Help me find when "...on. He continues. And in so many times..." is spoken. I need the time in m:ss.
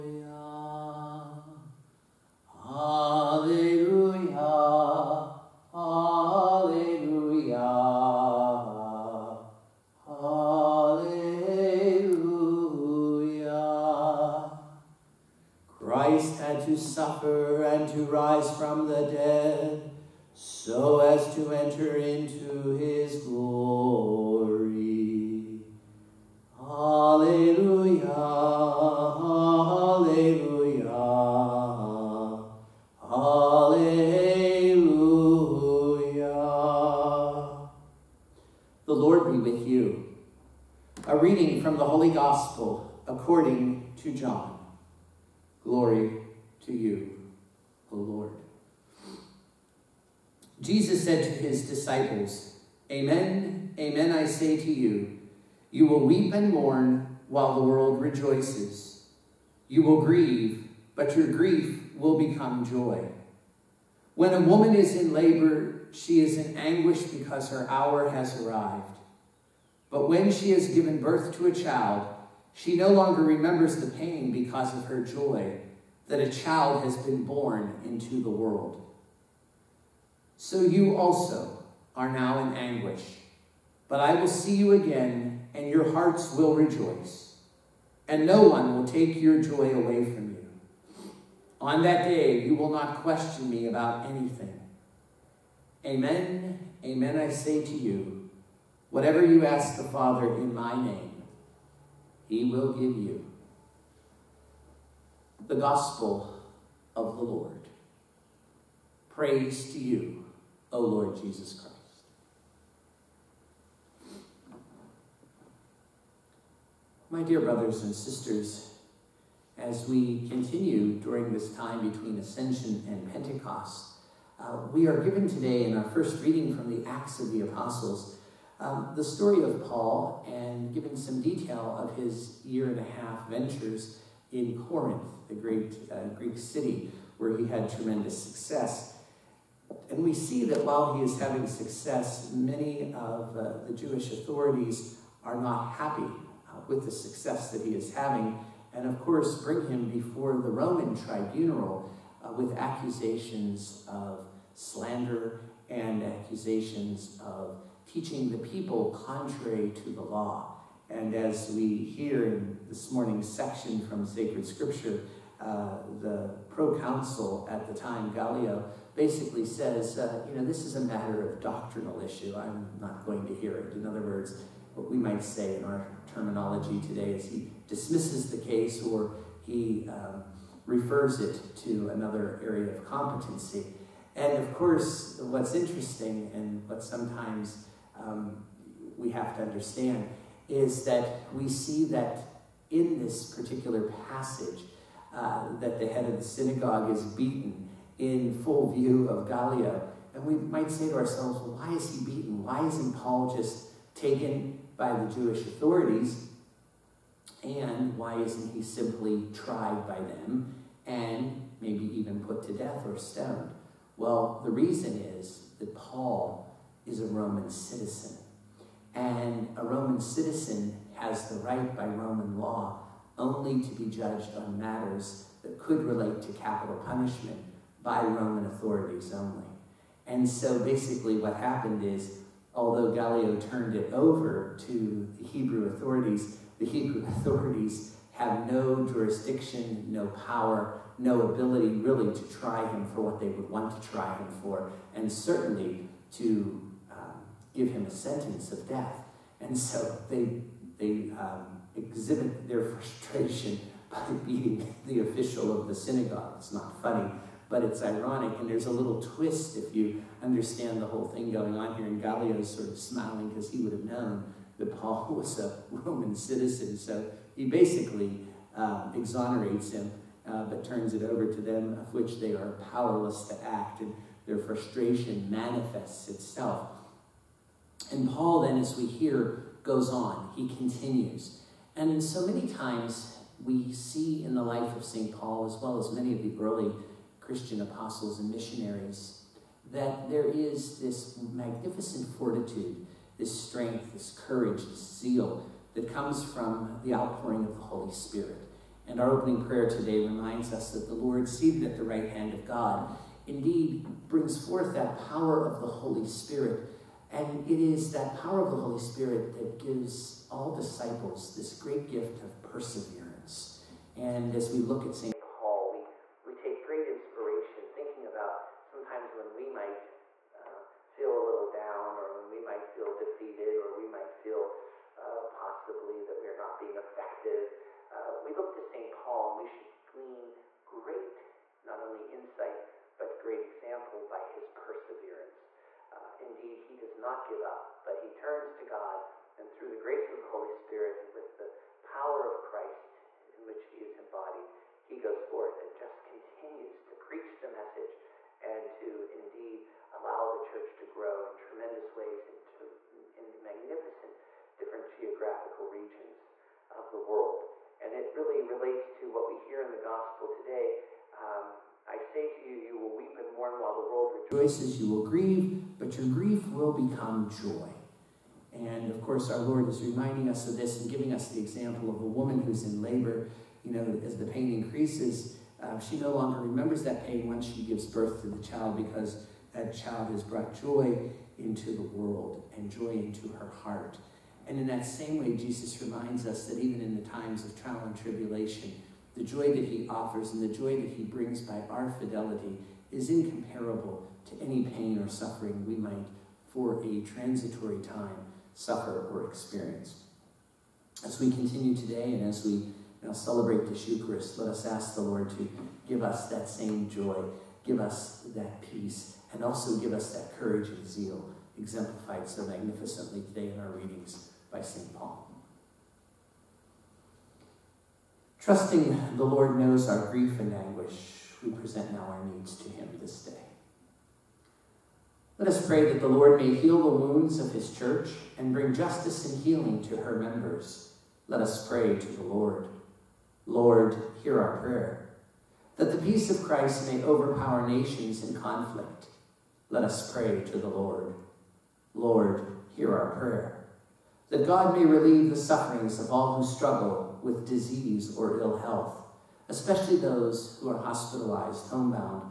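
4:39.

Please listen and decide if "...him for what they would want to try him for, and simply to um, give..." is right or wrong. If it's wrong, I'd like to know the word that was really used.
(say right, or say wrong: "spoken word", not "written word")
wrong: "certainly", not "simply".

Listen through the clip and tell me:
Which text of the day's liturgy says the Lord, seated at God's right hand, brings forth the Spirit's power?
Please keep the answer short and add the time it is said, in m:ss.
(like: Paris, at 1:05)
opening prayer, at 4:59.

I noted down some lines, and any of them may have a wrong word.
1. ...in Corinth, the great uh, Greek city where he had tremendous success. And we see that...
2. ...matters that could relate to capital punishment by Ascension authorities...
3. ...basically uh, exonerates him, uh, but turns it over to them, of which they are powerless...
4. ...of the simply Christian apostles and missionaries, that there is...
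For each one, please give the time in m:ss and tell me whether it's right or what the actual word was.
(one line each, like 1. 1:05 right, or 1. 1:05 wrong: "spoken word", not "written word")
1. 2:14 right
2. 3:44 wrong: "Roman", not "Ascension"
3. 4:27 right
4. 4:46 wrong: "early", not "simply".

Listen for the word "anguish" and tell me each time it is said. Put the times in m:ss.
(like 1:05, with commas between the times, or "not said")
1:06, 1:22, 7:00.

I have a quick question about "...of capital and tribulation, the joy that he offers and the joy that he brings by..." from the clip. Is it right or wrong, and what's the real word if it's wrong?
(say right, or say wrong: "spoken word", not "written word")
wrong: "trial", not "capital".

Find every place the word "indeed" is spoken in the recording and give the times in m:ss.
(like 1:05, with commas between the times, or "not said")
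5:03, 5:36, 5:49.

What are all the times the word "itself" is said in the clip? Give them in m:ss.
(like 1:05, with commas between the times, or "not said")
4:36.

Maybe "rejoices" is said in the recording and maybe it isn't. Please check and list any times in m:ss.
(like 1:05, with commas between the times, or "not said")
0:57, 1:26, 6:04.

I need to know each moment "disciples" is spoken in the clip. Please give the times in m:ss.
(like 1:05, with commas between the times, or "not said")
0:51, 5:10.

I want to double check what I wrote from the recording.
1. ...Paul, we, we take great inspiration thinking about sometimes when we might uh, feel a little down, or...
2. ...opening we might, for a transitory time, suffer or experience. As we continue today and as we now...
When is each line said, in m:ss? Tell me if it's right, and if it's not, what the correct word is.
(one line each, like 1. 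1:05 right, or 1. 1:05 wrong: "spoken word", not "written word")
1. 5:15 right
2. 6:35 wrong: "suffering", not "opening".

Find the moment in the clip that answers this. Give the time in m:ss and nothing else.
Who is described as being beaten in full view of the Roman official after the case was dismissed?
3:15.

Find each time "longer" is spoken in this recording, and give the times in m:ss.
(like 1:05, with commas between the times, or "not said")
1:12, 6:16.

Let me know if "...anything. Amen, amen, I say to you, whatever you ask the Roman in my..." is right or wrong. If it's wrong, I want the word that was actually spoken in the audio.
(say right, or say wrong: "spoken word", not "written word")
wrong: "Father", not "Roman".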